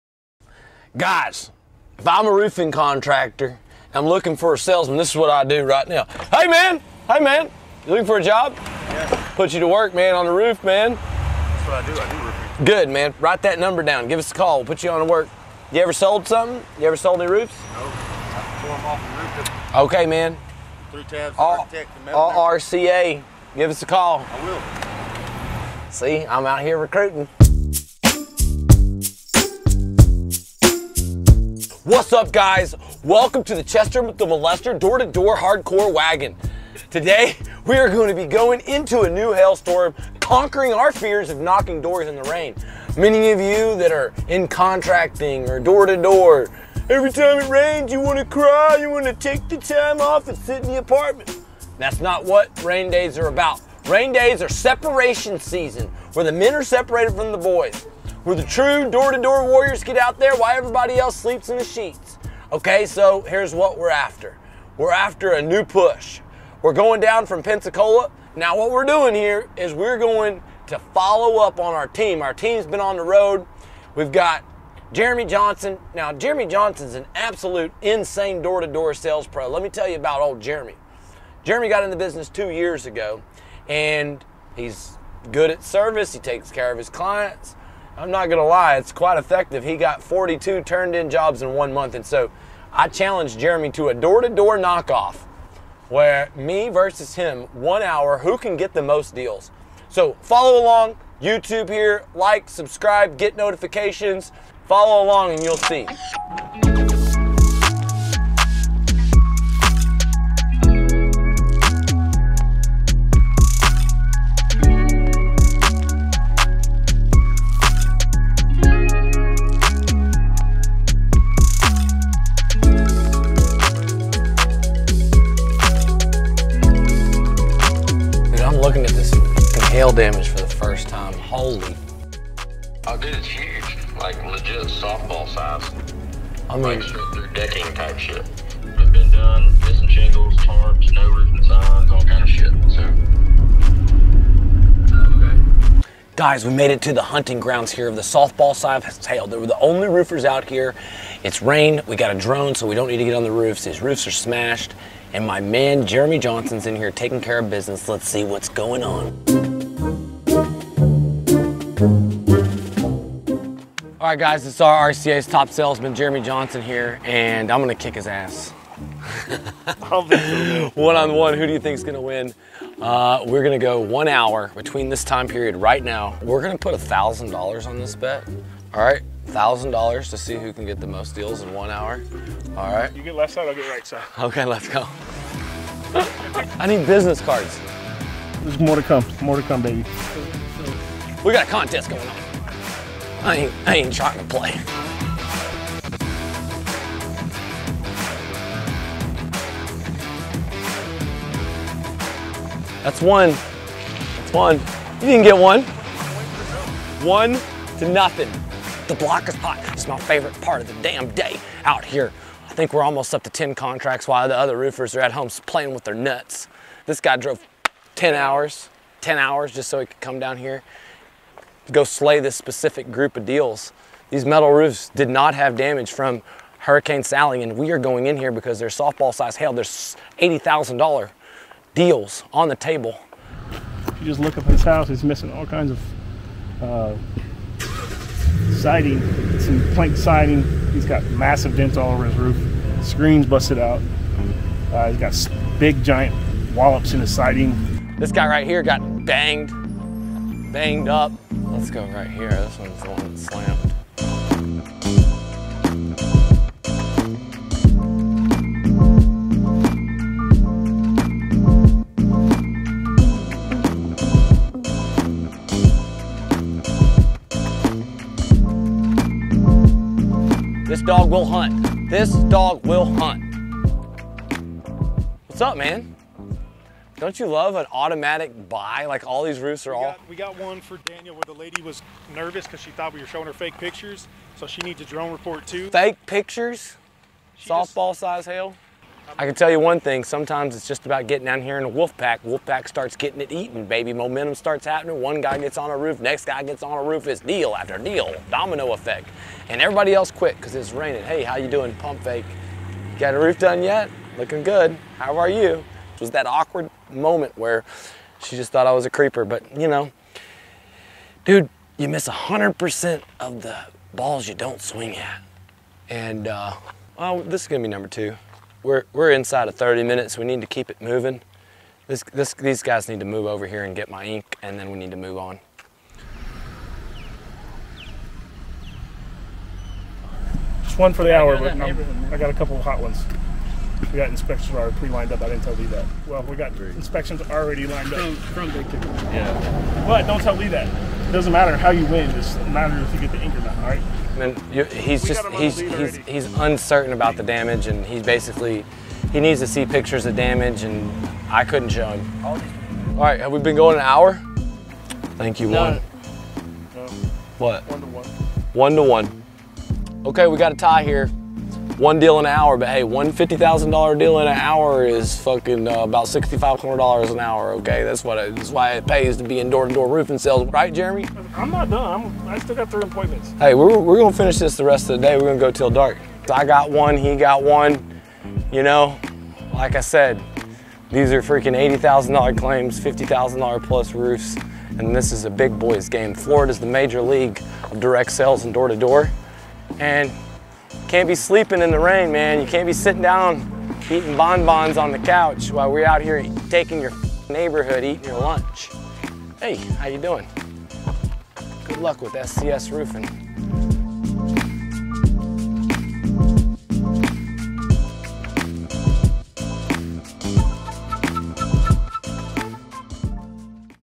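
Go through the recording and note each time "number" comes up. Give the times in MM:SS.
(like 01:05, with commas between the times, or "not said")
00:13, 05:17.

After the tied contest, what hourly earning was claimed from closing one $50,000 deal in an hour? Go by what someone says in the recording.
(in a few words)
$6,500.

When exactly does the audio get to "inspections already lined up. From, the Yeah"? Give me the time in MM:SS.
05:36.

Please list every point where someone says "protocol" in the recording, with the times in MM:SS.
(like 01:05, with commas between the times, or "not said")
not said.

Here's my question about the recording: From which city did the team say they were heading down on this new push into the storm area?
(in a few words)
Pensacola.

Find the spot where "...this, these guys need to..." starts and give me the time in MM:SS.
05:22.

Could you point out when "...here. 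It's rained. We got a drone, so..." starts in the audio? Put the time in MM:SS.
02:30.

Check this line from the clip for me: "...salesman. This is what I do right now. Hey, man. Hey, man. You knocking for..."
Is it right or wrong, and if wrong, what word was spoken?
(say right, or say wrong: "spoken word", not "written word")
wrong: "looking", not "knocking".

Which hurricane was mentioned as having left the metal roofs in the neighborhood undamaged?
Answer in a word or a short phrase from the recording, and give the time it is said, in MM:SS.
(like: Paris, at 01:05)
Hurricane Sally, at 03:46.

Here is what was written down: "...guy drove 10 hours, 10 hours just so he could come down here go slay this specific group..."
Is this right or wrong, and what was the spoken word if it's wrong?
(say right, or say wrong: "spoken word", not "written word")
right.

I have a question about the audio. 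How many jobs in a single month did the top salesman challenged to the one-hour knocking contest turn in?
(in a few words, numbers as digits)
42.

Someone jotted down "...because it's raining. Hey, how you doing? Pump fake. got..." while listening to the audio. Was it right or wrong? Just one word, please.
right.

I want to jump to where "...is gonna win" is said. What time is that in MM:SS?
02:51.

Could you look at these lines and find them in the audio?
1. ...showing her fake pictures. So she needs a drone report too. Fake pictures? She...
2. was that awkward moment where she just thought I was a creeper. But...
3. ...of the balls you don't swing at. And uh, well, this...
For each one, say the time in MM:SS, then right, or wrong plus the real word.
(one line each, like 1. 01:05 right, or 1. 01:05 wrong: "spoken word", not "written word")
1. 04:43 right
2. 05:06 right
3. 05:13 right.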